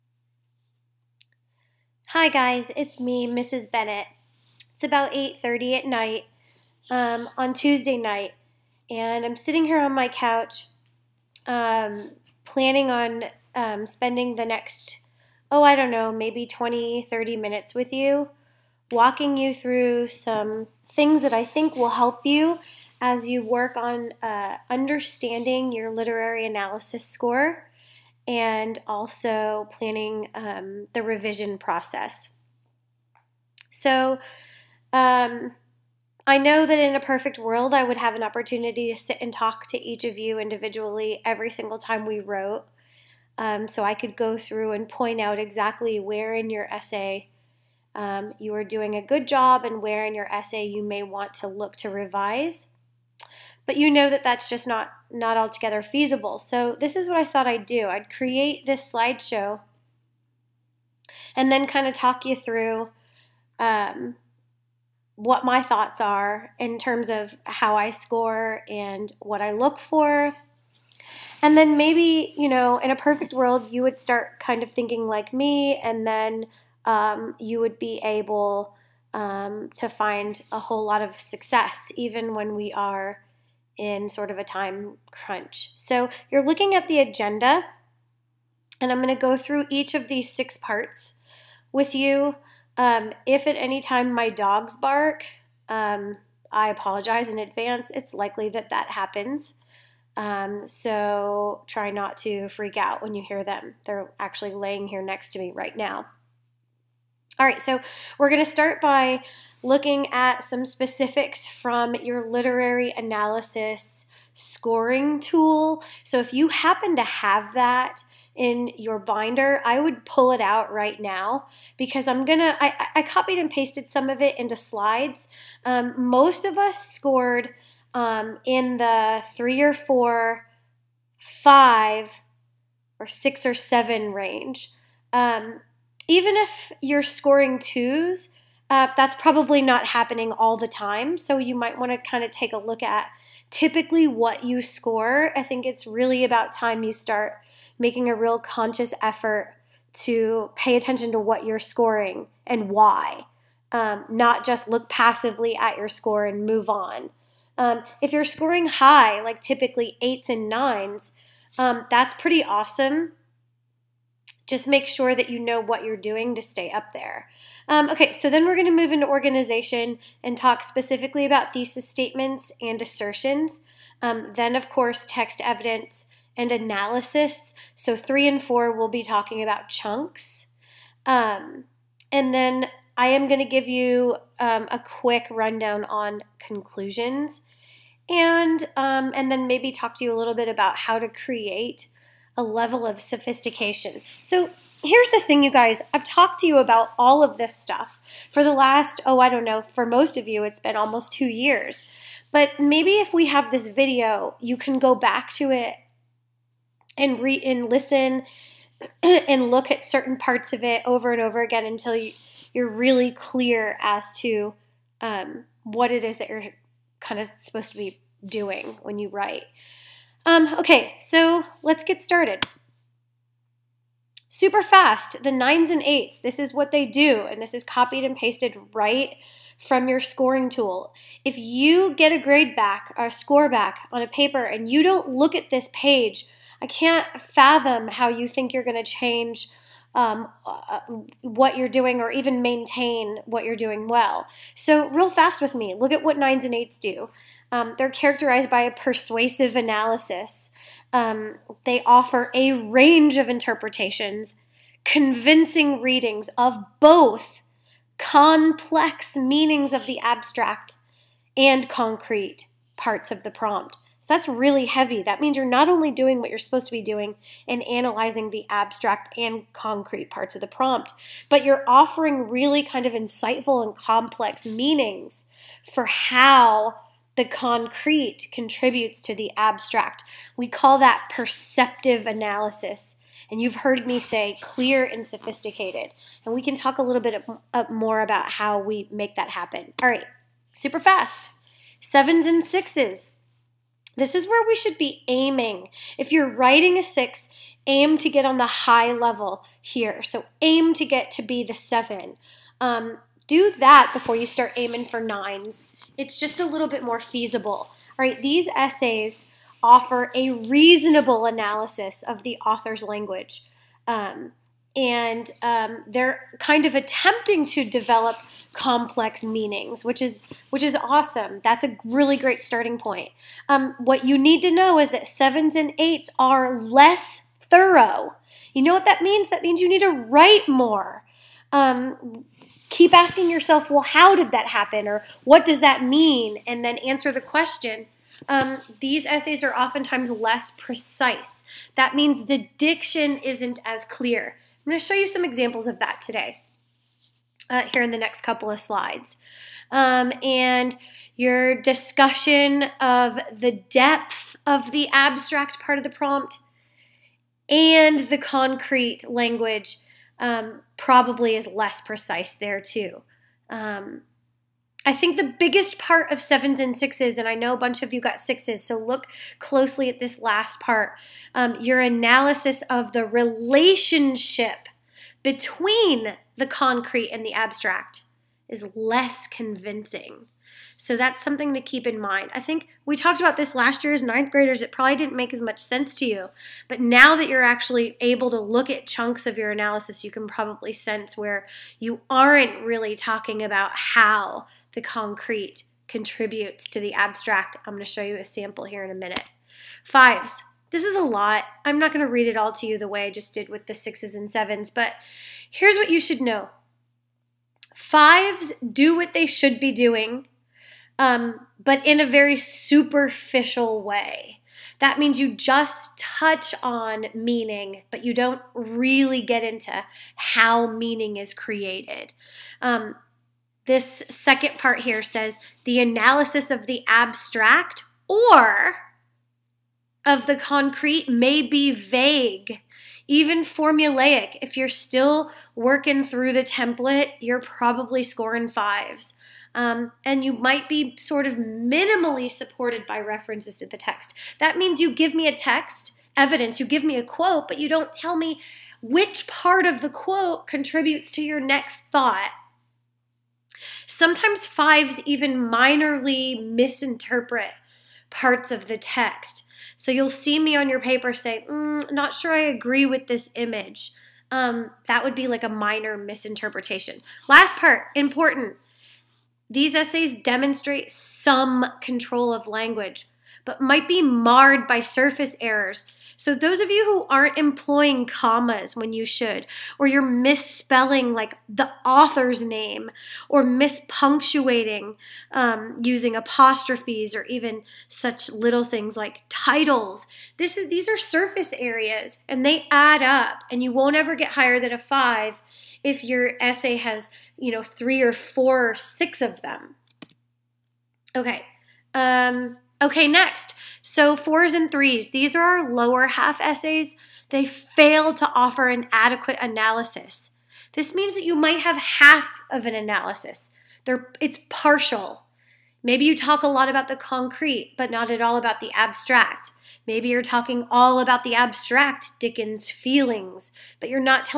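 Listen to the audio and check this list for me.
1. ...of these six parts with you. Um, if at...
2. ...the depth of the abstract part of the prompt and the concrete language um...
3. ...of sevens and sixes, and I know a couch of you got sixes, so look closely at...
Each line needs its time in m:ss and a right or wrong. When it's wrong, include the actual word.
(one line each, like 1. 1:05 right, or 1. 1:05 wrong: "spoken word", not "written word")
1. 1:29 right
2. 5:53 right
3. 6:06 wrong: "bunch", not "couch".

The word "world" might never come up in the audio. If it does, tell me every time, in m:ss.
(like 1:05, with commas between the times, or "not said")
0:37, 1:13.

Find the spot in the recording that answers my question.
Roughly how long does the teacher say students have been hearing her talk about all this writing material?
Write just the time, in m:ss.
3:20.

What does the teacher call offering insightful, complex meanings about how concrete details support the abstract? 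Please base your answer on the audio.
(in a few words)
perceptive analysis.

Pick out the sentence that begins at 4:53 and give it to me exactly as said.
This is where we should be aiming.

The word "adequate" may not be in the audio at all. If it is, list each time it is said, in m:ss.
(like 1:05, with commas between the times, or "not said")
8:28.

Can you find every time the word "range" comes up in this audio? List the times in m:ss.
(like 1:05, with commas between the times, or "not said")
2:14, 4:12.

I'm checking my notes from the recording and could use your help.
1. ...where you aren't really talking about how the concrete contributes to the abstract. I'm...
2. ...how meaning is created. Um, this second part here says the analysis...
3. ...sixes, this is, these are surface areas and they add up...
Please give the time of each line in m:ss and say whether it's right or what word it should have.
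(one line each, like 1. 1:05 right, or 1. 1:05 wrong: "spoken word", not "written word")
1. 6:31 right
2. 7:00 right
3. 8:09 wrong: "titles", not "sixes".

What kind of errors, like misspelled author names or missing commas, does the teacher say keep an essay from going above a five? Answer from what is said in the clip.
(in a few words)
surface errors.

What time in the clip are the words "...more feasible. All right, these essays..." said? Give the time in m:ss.
5:06.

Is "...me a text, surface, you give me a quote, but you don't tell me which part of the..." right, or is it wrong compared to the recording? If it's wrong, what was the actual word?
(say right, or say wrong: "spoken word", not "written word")
wrong: "evidence", not "surface".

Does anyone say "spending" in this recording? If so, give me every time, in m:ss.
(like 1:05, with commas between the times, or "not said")
0:13.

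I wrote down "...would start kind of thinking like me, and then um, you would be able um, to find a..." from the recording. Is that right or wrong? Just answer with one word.
right.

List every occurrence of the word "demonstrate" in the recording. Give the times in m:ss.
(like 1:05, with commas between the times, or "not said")
7:50.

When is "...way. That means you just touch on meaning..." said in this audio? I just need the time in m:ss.
6:53.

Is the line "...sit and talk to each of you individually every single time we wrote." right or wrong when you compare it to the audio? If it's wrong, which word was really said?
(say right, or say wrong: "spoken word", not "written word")
right.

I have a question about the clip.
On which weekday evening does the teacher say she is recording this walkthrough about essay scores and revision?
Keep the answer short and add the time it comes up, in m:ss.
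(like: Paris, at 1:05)
Tuesday, at 0:07.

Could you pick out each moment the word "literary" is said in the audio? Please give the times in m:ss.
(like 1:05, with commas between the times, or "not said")
0:25, 1:52.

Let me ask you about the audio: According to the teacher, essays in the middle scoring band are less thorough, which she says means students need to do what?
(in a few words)
write more.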